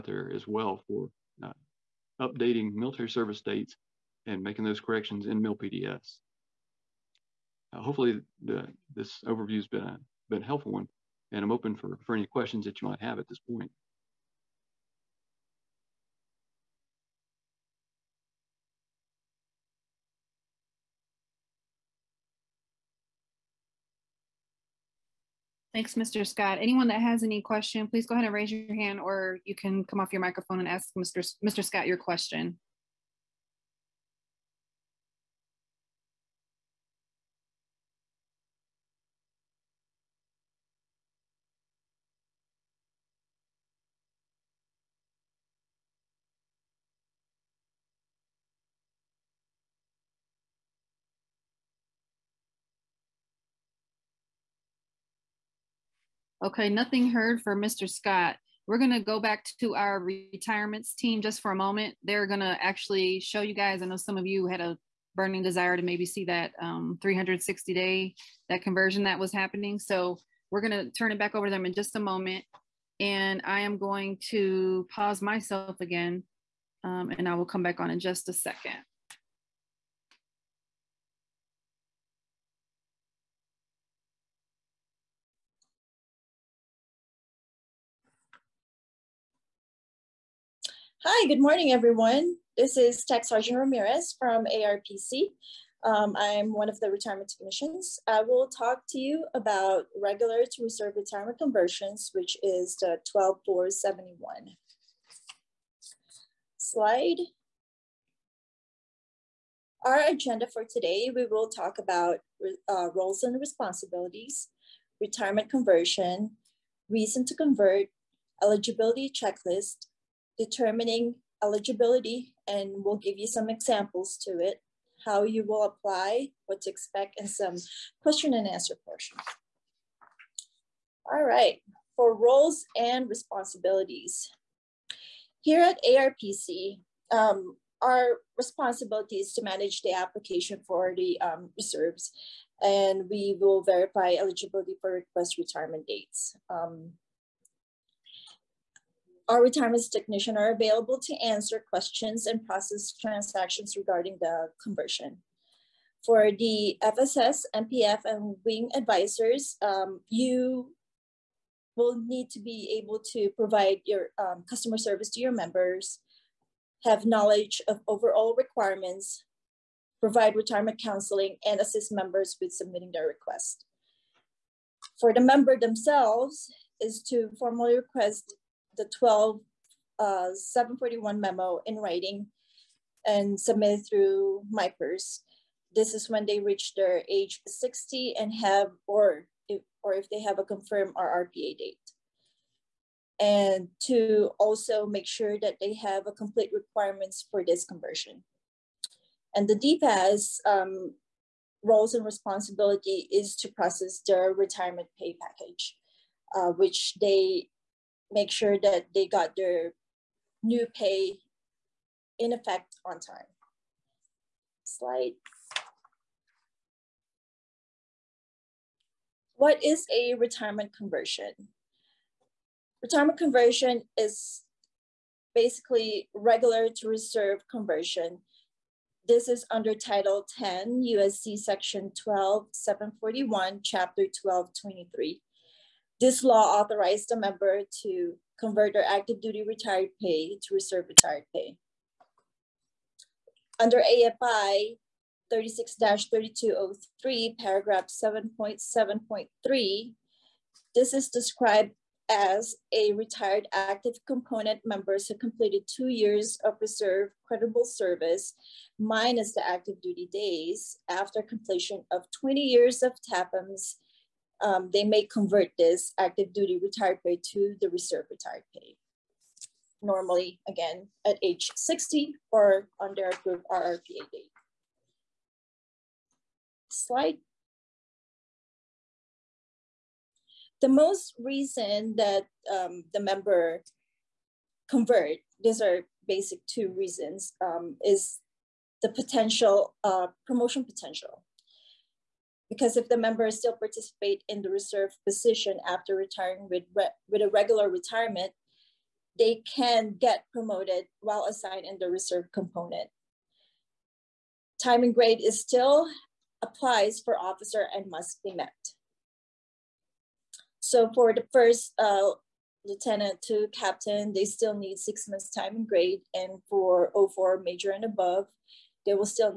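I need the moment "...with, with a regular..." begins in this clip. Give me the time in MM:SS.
04:56.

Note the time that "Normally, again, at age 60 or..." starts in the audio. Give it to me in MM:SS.
04:29.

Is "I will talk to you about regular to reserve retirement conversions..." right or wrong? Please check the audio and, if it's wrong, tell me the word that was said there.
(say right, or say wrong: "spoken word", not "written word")
right.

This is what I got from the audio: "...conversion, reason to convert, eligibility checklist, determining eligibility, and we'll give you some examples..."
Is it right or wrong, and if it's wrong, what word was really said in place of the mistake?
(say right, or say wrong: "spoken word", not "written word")
right.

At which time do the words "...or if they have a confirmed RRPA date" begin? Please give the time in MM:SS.
03:09.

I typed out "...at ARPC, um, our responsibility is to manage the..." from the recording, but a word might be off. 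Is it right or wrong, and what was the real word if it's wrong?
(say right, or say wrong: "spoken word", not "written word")
right.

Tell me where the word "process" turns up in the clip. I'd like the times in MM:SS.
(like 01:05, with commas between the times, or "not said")
02:32, 03:23.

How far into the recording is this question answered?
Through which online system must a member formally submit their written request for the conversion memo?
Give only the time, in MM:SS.
03:04.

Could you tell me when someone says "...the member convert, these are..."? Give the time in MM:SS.
04:42.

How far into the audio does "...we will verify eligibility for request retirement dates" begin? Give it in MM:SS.
02:23.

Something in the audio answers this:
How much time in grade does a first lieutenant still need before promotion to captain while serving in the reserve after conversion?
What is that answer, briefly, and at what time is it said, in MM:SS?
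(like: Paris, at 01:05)
6 months, at 05:14.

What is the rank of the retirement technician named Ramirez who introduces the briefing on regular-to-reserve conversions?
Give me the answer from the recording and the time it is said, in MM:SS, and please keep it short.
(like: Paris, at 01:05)
Tech Sergeant, at 01:33.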